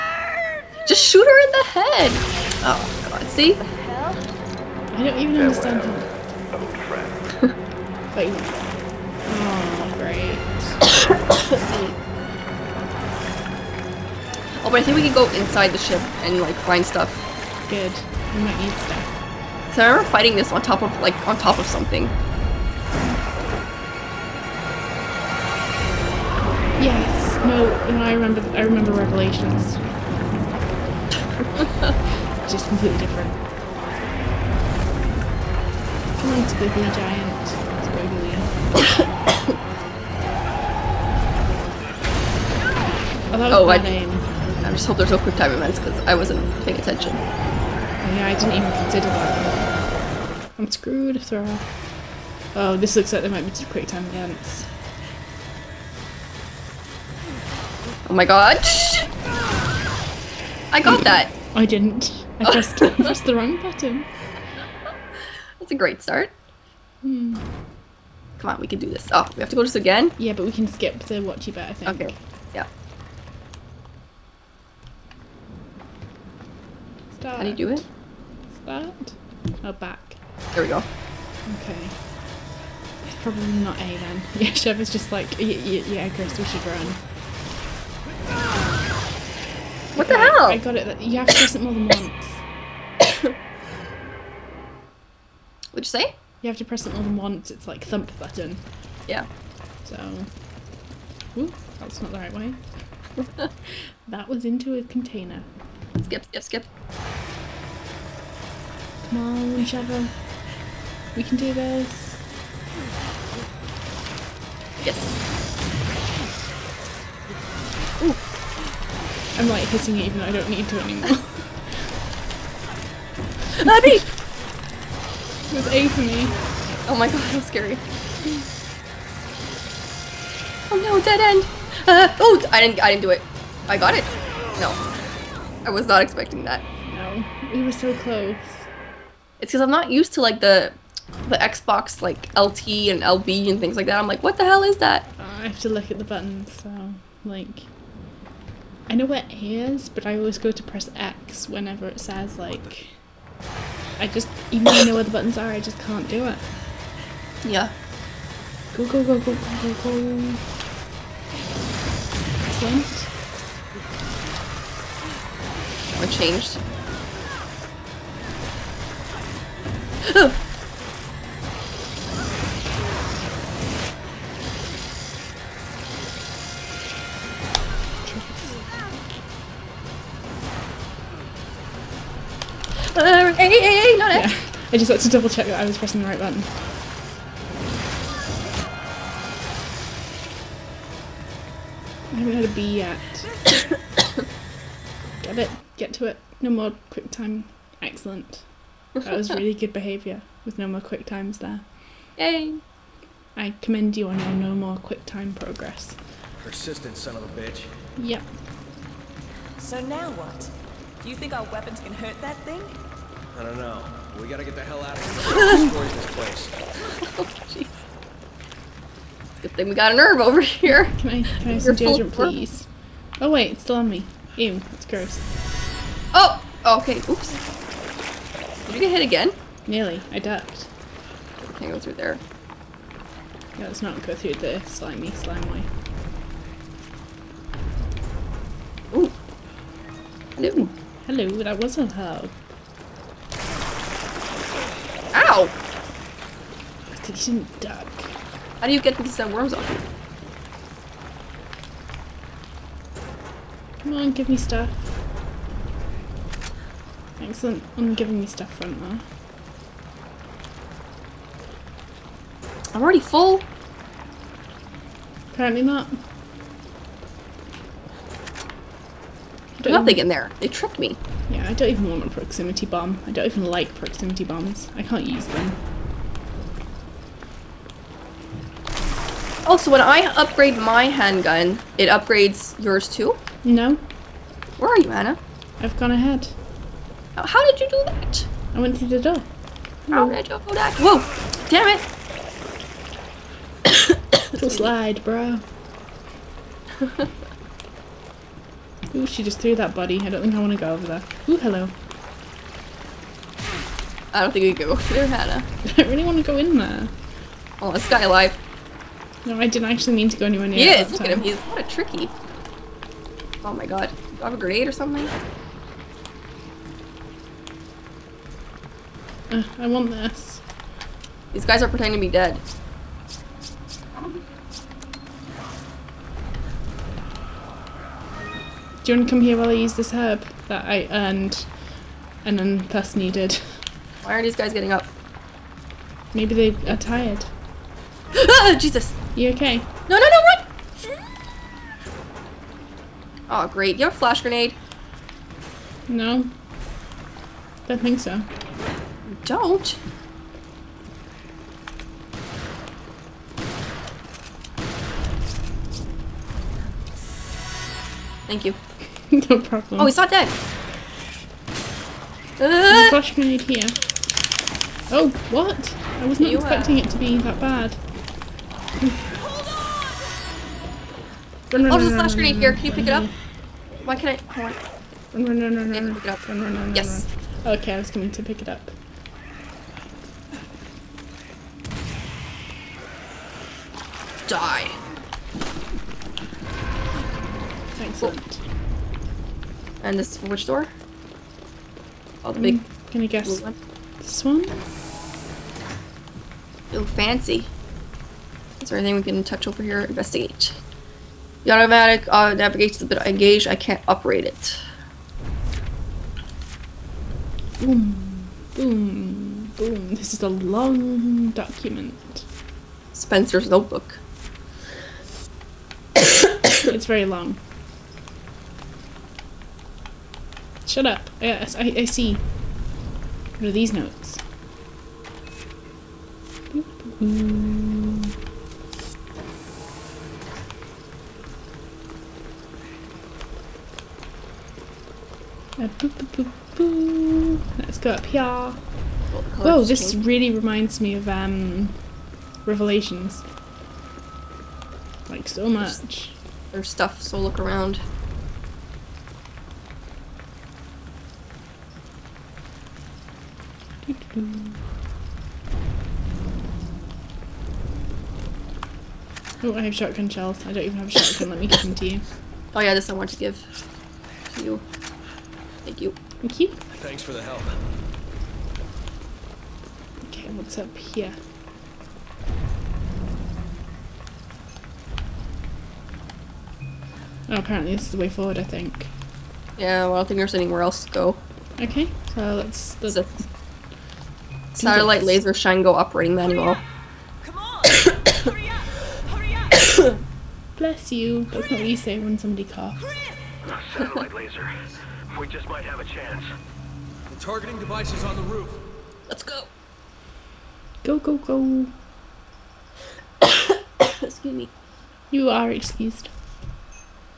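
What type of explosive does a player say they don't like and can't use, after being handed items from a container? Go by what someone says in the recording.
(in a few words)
Proximity bomb.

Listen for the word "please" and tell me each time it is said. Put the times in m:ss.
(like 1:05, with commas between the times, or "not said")
3:42.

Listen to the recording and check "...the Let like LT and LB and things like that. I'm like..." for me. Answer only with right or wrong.
wrong.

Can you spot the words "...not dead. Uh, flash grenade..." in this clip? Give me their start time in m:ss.
5:59.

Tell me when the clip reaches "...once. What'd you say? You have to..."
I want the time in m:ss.
1:31.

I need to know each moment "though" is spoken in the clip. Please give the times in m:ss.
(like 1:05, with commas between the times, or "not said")
2:00, 2:34.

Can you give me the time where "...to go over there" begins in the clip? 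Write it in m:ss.
5:00.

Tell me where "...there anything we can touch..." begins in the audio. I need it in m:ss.
6:38.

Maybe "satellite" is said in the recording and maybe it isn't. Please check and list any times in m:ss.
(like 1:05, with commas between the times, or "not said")
8:04, 8:13.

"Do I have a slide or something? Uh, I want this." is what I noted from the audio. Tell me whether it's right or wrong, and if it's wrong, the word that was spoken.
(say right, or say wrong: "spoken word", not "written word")
wrong: "grenade", not "slide".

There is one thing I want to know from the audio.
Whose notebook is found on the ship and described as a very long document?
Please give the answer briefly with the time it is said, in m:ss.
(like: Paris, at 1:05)
Spencer, at 6:52.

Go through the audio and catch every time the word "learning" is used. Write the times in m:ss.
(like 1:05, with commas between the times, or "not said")
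not said.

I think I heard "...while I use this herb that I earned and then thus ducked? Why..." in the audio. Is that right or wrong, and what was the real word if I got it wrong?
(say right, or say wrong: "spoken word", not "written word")
wrong: "needed", not "ducked".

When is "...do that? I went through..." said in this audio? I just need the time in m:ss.
4:47.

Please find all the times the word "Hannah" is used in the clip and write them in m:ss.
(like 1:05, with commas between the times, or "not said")
5:05.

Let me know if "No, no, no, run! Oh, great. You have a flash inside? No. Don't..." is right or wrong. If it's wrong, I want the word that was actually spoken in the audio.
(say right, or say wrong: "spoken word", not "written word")
wrong: "grenade", not "inside".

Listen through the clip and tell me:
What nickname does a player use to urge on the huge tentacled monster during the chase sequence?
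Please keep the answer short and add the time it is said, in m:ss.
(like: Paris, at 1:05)
Squiggly Giant, at 0:36.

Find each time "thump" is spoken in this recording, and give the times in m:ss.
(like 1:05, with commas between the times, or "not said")
1:37.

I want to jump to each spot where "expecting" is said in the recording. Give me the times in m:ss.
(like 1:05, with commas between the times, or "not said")
2:15, 6:06.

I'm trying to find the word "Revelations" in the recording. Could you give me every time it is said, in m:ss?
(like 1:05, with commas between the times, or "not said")
0:28, 7:22.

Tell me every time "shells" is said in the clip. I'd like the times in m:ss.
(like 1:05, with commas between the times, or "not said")
7:40.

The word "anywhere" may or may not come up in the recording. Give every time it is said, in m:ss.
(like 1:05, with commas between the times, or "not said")
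5:10, 8:00.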